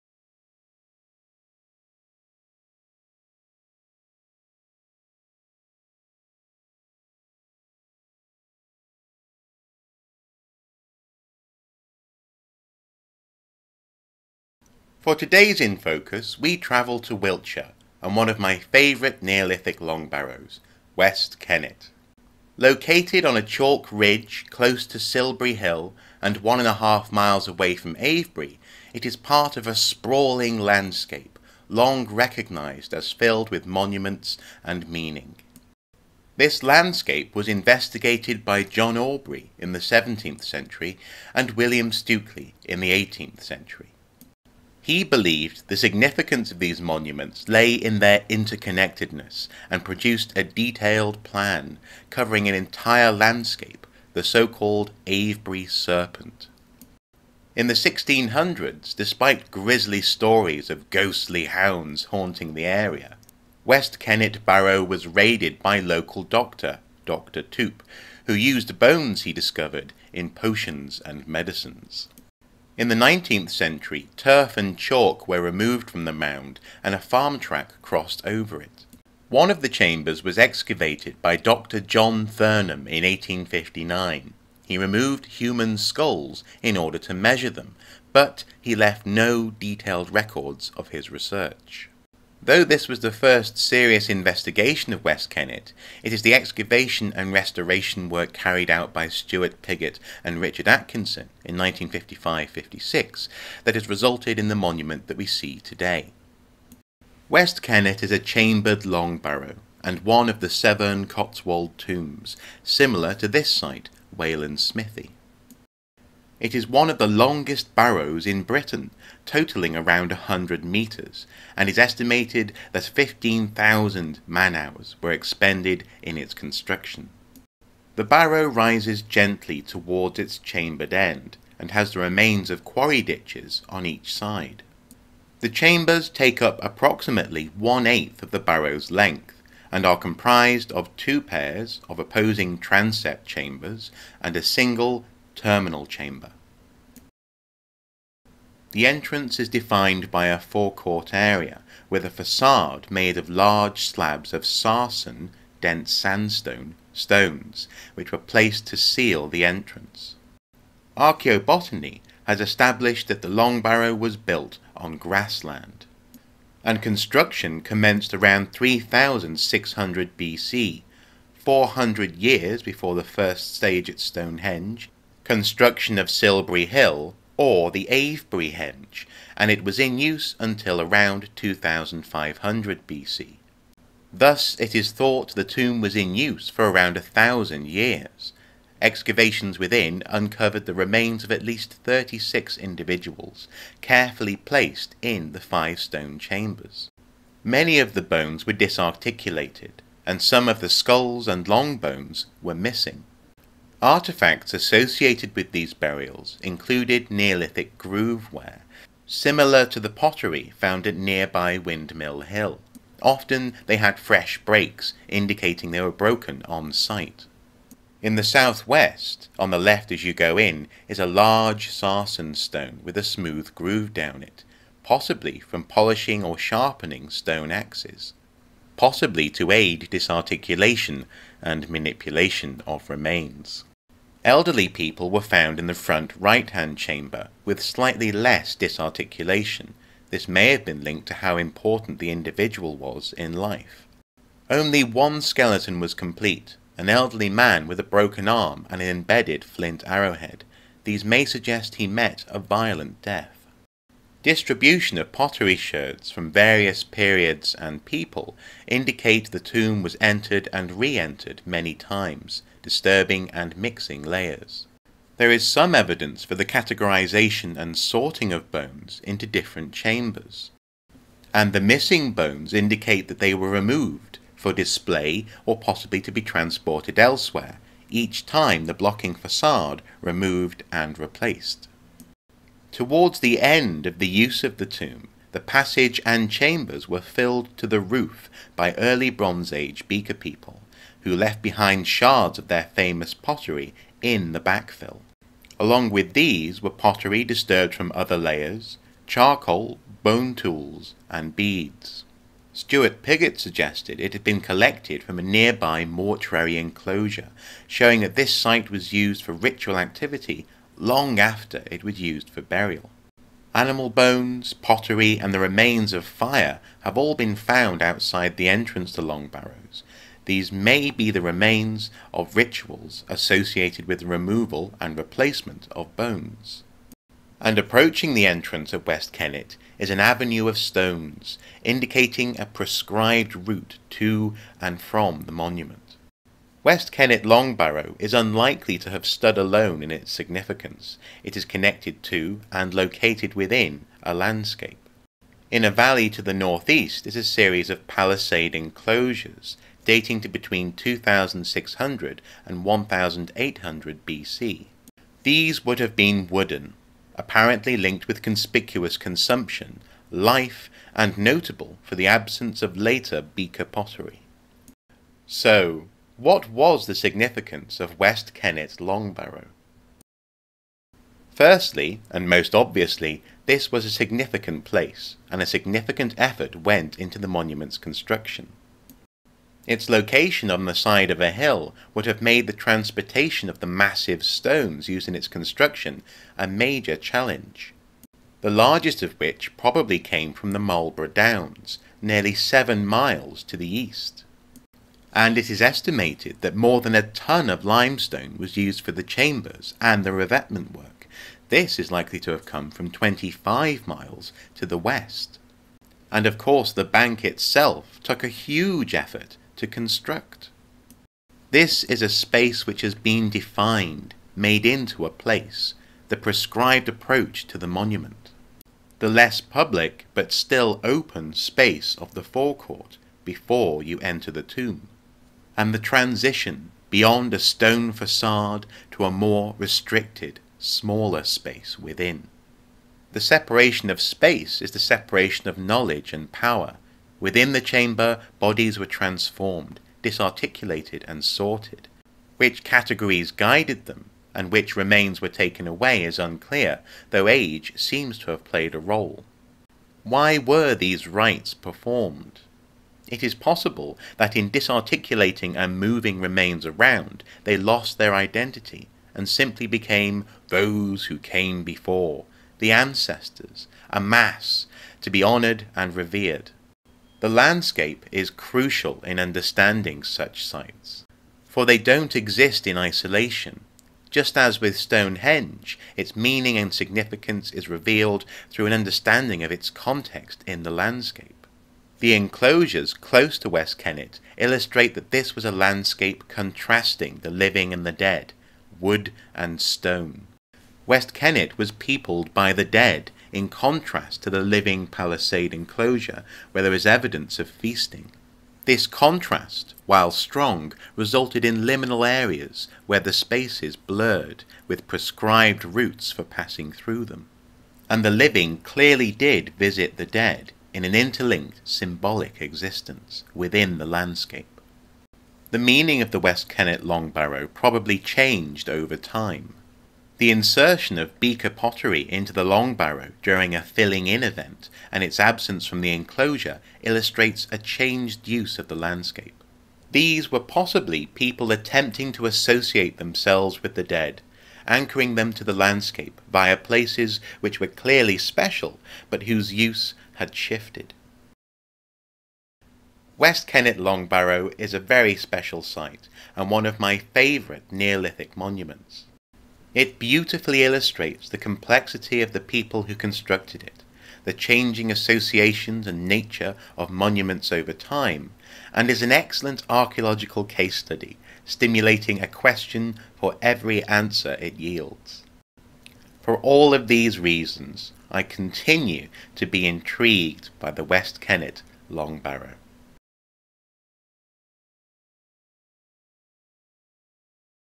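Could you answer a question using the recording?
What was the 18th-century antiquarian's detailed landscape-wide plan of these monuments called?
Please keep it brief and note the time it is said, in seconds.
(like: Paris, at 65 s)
Avebury Serpent, at 55 s.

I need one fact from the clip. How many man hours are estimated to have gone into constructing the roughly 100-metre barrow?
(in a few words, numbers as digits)
15,000.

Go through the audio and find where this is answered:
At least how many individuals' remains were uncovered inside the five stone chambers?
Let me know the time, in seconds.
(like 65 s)
191 s.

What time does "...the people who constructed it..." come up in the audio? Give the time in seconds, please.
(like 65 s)
552 s.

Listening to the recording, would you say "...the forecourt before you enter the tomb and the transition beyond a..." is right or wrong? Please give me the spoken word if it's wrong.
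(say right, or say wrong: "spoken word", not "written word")
right.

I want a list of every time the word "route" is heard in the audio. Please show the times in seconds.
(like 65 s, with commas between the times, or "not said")
333 s, 505 s.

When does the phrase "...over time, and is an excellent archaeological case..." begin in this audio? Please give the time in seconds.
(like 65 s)
557 s.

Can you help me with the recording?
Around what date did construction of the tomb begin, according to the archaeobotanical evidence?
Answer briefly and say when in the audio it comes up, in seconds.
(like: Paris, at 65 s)
3600 BC, at 168 s.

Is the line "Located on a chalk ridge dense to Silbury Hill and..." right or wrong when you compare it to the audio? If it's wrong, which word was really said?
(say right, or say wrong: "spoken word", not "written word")
wrong: "close", not "dense".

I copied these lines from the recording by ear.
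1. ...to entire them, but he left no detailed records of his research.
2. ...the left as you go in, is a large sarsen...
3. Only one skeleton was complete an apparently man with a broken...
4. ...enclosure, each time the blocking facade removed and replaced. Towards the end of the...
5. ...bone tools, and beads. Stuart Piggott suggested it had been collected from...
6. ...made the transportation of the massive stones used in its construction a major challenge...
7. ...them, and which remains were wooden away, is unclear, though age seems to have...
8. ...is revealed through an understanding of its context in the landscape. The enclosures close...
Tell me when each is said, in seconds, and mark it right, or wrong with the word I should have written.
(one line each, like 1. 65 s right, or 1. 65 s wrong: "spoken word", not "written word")
1. 86 s wrong: "measure", not "entire"
2. 219 s right
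3. 244 s wrong: "elderly", not "apparently"
4. 276 s wrong: "elsewhere", not "enclosure"
5. 300 s right
6. 382 s right
7. 443 s wrong: "taken", not "wooden"
8. 477 s right.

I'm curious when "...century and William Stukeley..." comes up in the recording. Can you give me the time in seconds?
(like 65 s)
40 s.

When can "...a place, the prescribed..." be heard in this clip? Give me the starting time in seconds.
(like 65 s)
415 s.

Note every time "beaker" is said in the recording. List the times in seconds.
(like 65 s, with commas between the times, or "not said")
289 s, 363 s, 521 s.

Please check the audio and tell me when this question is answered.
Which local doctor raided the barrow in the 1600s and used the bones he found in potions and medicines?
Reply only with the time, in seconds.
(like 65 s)
67 s.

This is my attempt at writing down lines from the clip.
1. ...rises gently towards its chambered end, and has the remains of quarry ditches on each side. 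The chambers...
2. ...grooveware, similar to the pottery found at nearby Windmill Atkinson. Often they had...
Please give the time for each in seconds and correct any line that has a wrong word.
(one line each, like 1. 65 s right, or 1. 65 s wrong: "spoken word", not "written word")
1. 128 s right
2. 207 s wrong: "Hill", not "Atkinson".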